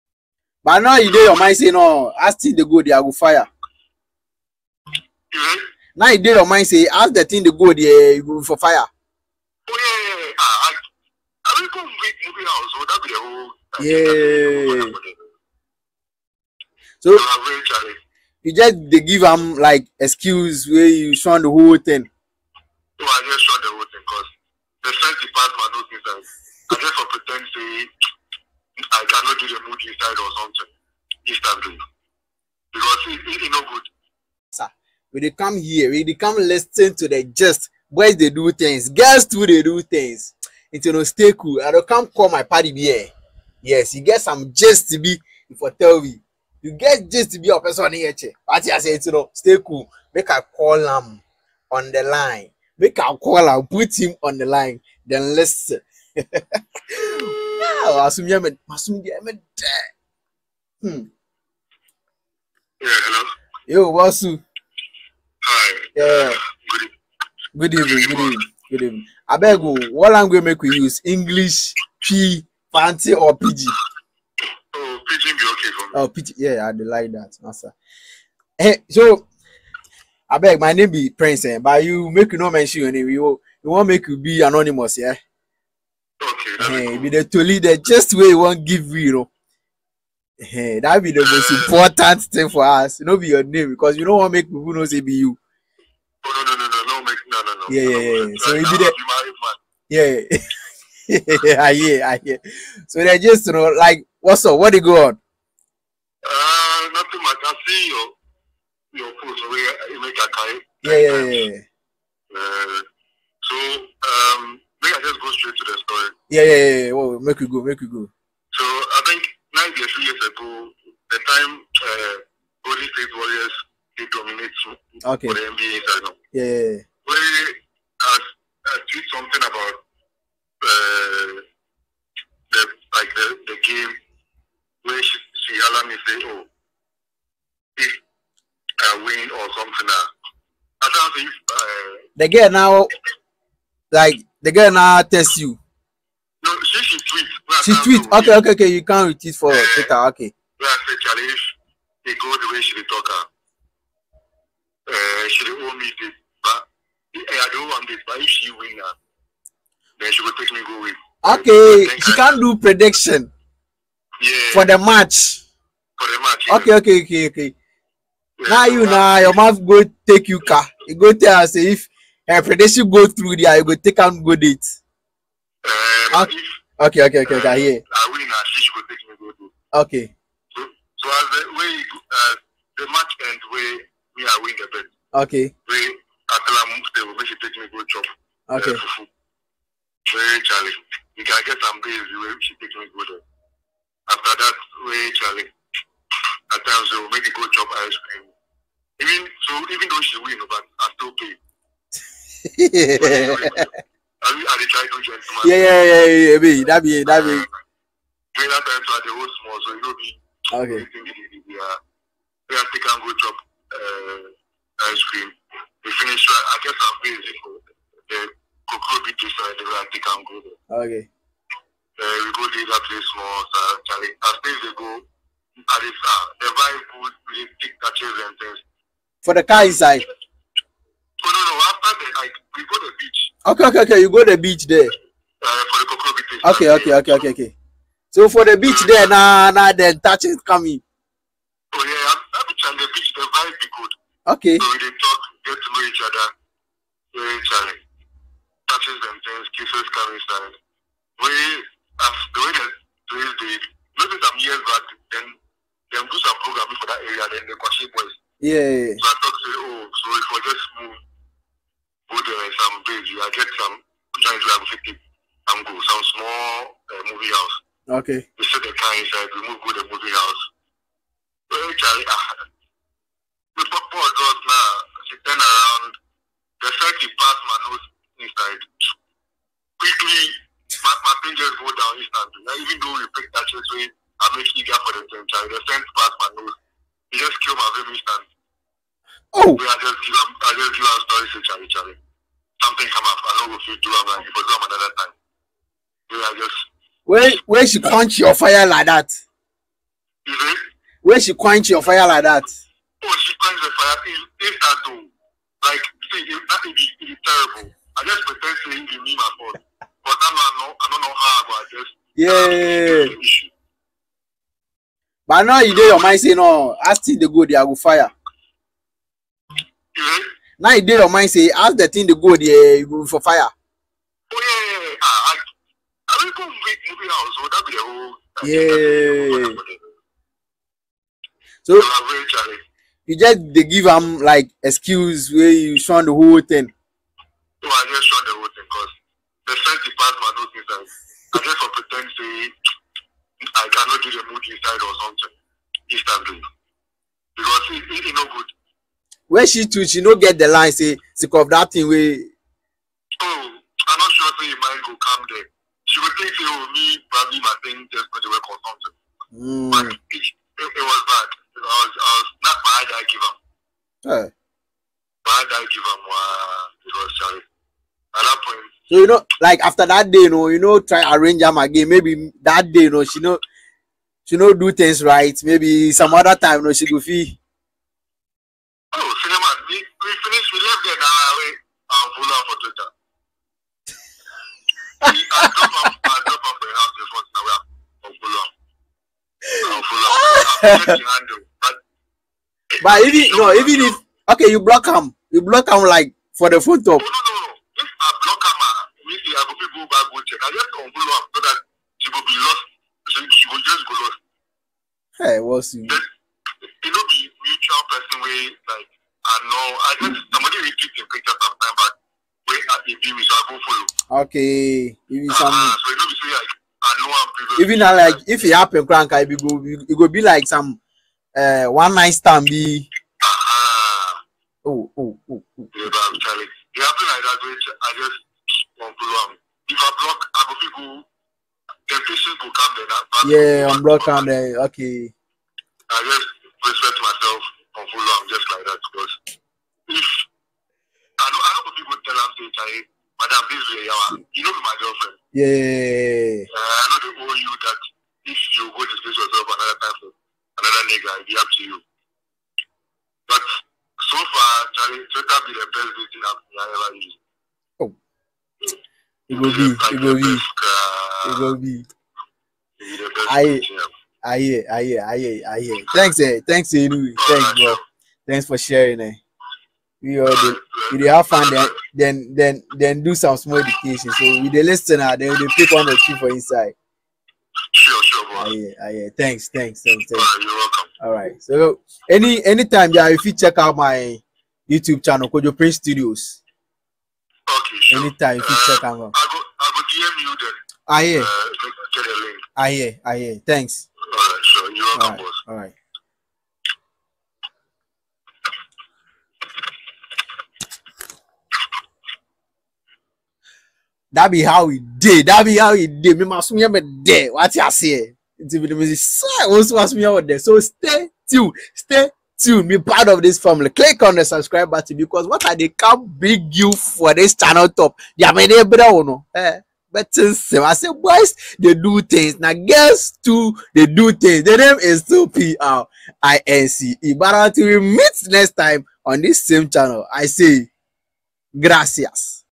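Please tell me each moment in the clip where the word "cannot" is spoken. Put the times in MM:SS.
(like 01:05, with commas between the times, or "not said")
00:29, 05:43.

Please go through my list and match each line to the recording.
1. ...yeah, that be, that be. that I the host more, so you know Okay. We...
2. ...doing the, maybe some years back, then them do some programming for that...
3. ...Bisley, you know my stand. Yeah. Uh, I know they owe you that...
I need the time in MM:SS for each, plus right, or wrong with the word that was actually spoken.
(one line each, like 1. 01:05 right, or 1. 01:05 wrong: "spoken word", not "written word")
1. 03:26 right
2. 04:13 right
3. 07:23 wrong: "girlfriend", not "stand".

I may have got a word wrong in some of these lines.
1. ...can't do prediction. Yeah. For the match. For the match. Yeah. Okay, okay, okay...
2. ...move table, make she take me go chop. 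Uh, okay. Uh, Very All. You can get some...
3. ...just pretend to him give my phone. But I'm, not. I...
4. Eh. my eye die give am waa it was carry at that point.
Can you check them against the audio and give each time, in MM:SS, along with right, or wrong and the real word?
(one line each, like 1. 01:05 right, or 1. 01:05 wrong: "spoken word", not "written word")
1. 02:42 right
2. 03:06 wrong: "Charlie", not "All"
3. 05:08 right
4. 06:04 wrong: "sorry", not "carry".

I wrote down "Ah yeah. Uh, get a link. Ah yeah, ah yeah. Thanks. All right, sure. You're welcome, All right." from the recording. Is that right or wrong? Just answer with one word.
right.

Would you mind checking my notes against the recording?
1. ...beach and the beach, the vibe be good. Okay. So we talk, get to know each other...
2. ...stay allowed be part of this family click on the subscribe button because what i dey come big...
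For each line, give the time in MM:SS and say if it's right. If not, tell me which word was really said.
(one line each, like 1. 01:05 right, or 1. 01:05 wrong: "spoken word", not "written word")
1. 04:02 right
2. 08:31 wrong: "tuned", not "allowed".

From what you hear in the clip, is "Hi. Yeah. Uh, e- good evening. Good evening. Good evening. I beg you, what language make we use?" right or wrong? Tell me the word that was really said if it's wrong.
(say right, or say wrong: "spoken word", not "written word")
right.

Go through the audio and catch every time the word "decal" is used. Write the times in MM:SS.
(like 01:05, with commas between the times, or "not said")
not said.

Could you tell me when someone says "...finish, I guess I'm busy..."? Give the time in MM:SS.
03:35.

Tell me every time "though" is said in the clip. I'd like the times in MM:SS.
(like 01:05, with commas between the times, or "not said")
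03:19, 04:42.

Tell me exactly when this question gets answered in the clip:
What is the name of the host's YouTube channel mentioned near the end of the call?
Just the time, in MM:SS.
08:05.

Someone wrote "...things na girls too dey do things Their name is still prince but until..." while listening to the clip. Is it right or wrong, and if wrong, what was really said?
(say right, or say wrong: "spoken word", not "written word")
right.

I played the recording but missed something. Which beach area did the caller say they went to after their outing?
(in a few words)
Kokrobite.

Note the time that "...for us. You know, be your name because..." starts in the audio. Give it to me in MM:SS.
01:32.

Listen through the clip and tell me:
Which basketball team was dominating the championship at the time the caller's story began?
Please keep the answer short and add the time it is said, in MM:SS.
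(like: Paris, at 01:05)
Golden State Warriors, at 02:02.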